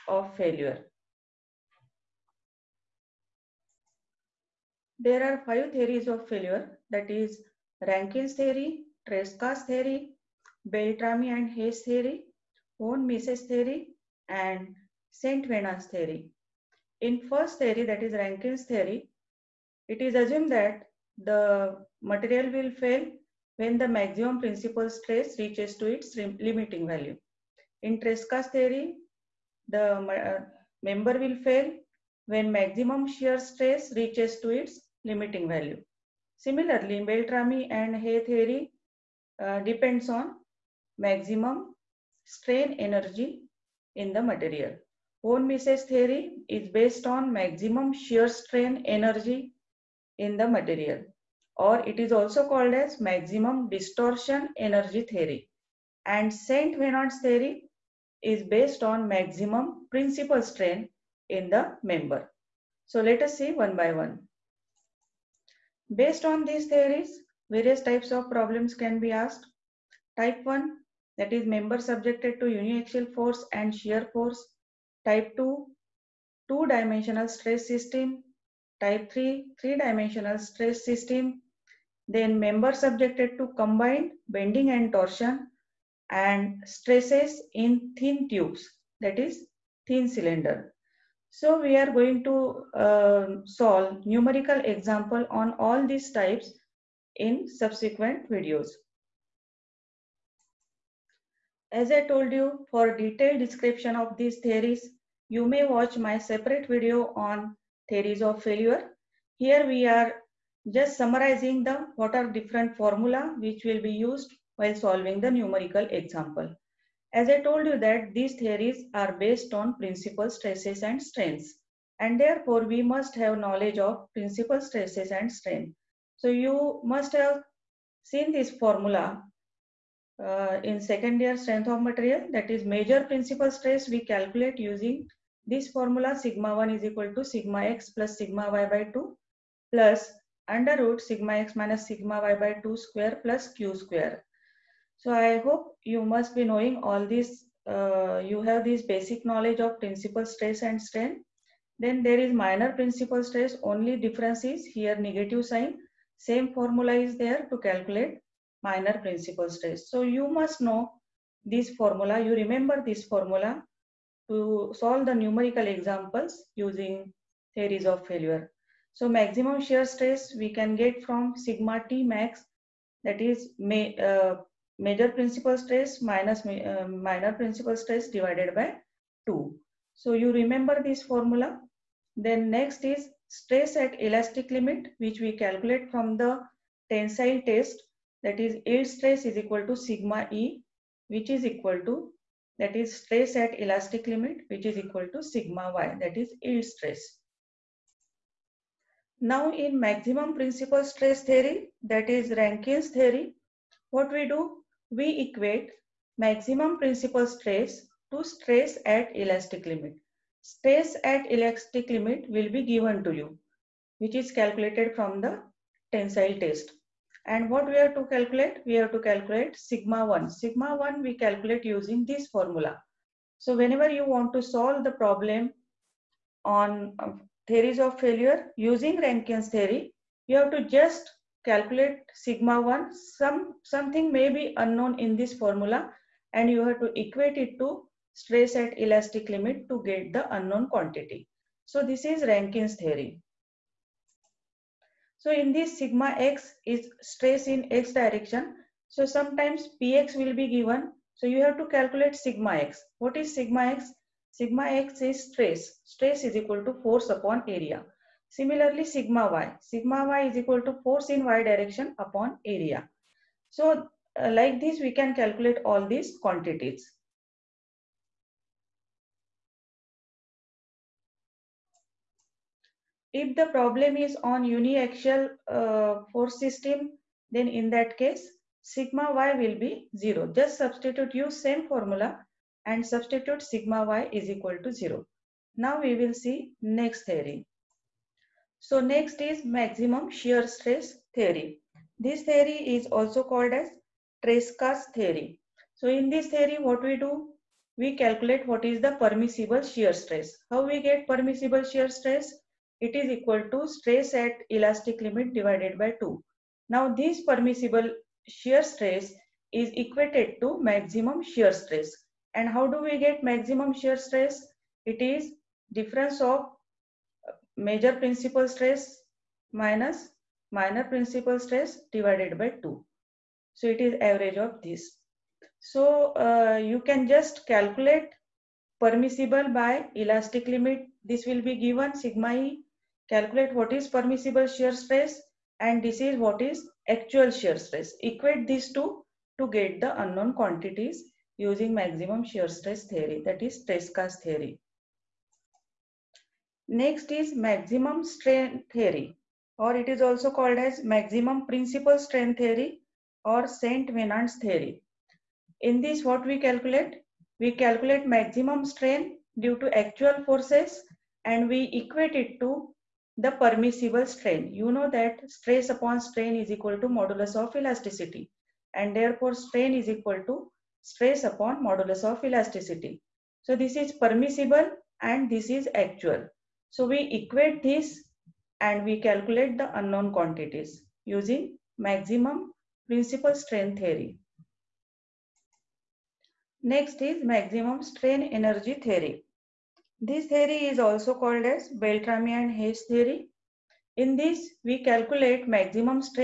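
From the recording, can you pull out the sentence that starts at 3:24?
We equate maximum principal stress to stress at elastic limit.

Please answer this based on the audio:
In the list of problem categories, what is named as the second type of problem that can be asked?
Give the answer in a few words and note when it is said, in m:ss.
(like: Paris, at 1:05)
Two-dimensional stress system, at 1:16.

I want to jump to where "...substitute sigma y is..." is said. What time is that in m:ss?
4:42.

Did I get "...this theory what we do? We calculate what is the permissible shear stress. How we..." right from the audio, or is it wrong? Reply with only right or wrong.
right.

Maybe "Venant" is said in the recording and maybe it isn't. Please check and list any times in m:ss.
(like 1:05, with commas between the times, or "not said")
0:15, 0:56, 5:53.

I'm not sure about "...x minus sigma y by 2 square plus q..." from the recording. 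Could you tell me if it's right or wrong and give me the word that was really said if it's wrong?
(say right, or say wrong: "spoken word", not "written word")
right.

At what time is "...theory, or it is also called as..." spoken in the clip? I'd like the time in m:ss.
5:48.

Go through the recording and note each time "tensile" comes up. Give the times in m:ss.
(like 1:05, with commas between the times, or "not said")
3:06, 3:35.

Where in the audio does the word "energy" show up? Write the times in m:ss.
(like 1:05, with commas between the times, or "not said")
0:42, 0:48, 0:54, 6:28.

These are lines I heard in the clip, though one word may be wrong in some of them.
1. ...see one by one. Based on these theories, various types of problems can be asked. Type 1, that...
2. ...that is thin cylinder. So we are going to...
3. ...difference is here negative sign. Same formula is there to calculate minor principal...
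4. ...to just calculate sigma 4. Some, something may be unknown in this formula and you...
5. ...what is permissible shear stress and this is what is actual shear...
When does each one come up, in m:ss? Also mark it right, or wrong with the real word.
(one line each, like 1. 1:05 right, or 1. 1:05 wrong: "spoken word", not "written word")
1. 1:03 right
2. 1:28 right
3. 2:33 right
4. 3:50 wrong: "1", not "4"
5. 5:33 right.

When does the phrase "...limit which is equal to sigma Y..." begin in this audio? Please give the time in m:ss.
3:14.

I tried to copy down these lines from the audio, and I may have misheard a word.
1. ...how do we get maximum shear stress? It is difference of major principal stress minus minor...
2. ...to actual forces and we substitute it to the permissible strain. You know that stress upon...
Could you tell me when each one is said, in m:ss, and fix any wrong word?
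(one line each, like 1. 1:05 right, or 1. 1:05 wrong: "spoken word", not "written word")
1. 5:12 right
2. 5:59 wrong: "equate", not "substitute".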